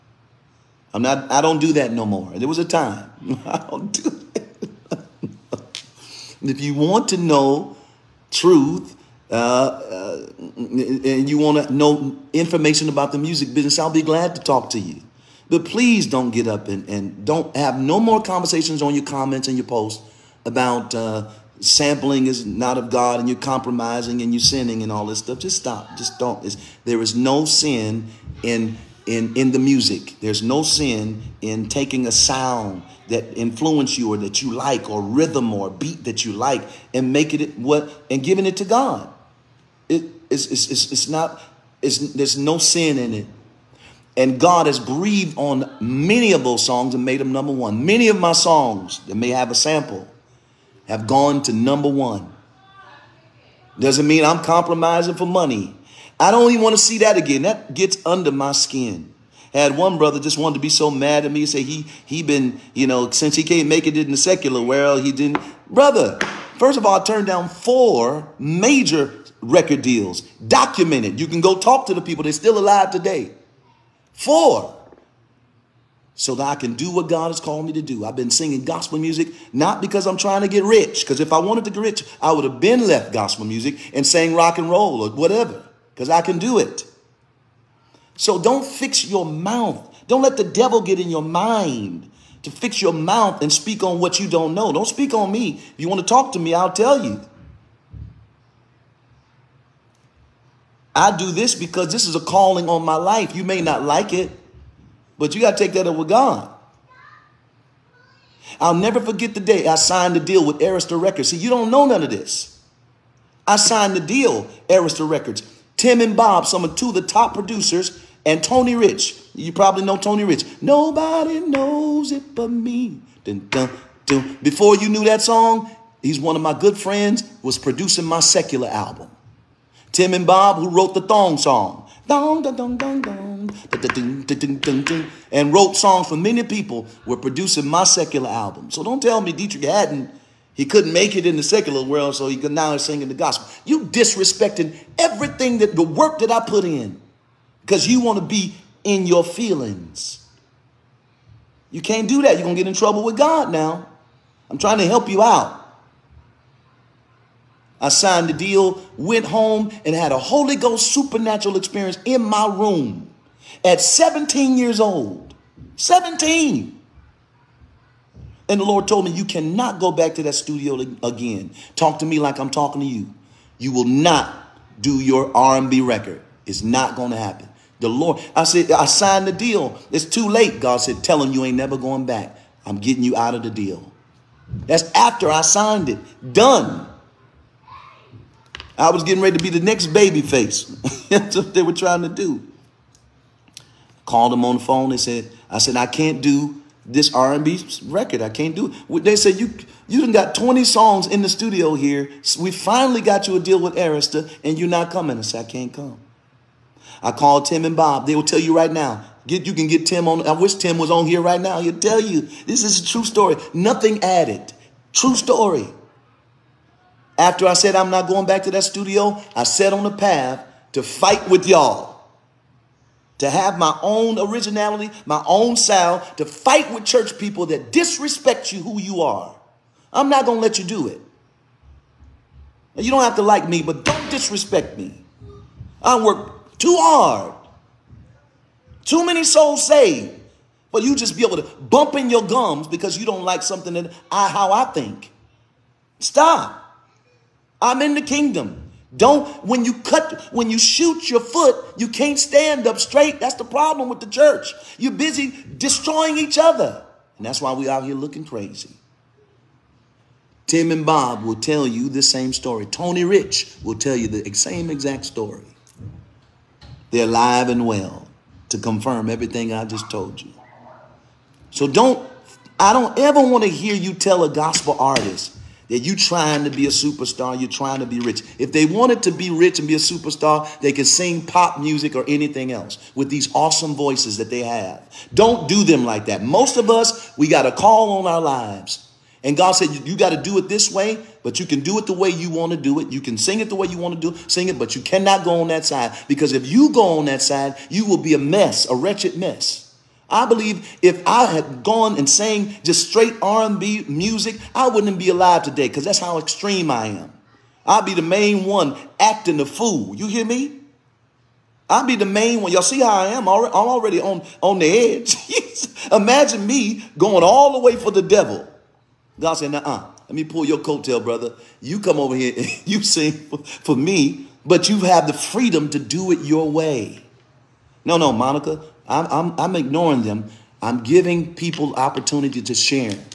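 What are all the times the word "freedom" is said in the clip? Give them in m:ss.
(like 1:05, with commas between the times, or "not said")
5:25.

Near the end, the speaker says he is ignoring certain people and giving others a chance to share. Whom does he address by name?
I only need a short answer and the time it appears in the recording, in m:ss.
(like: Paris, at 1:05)
Monica, at 5:28.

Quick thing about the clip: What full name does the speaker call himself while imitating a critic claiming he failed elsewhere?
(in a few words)
Deitrick Haddon.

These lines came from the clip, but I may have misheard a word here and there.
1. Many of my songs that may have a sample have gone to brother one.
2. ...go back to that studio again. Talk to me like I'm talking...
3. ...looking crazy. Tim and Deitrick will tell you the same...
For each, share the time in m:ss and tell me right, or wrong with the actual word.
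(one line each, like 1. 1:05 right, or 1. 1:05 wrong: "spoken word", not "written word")
1. 0:47 wrong: "number", not "brother"
2. 2:49 right
3. 4:17 wrong: "Bob", not "Deitrick".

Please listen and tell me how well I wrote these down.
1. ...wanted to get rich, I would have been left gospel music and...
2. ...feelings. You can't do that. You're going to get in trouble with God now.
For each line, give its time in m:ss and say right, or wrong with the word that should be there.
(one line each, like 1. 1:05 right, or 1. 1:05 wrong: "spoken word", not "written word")
1. 1:21 right
2. 2:29 right.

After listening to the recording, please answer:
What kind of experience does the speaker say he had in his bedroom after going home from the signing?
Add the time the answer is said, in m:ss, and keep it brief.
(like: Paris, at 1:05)
Holy Ghost supernatural experience, at 2:40.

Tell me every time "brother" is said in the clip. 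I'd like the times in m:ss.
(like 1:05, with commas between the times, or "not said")
0:59, 1:05, 5:21.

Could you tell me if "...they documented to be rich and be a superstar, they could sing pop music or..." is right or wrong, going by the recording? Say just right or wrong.
wrong.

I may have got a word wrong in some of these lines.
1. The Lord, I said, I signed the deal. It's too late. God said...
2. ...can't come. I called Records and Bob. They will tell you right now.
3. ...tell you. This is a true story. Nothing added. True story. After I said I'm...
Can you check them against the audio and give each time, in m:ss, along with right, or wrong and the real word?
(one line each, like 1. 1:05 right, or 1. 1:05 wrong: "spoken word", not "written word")
1. 2:57 right
2. 3:25 wrong: "Tim", not "Records"
3. 3:31 right.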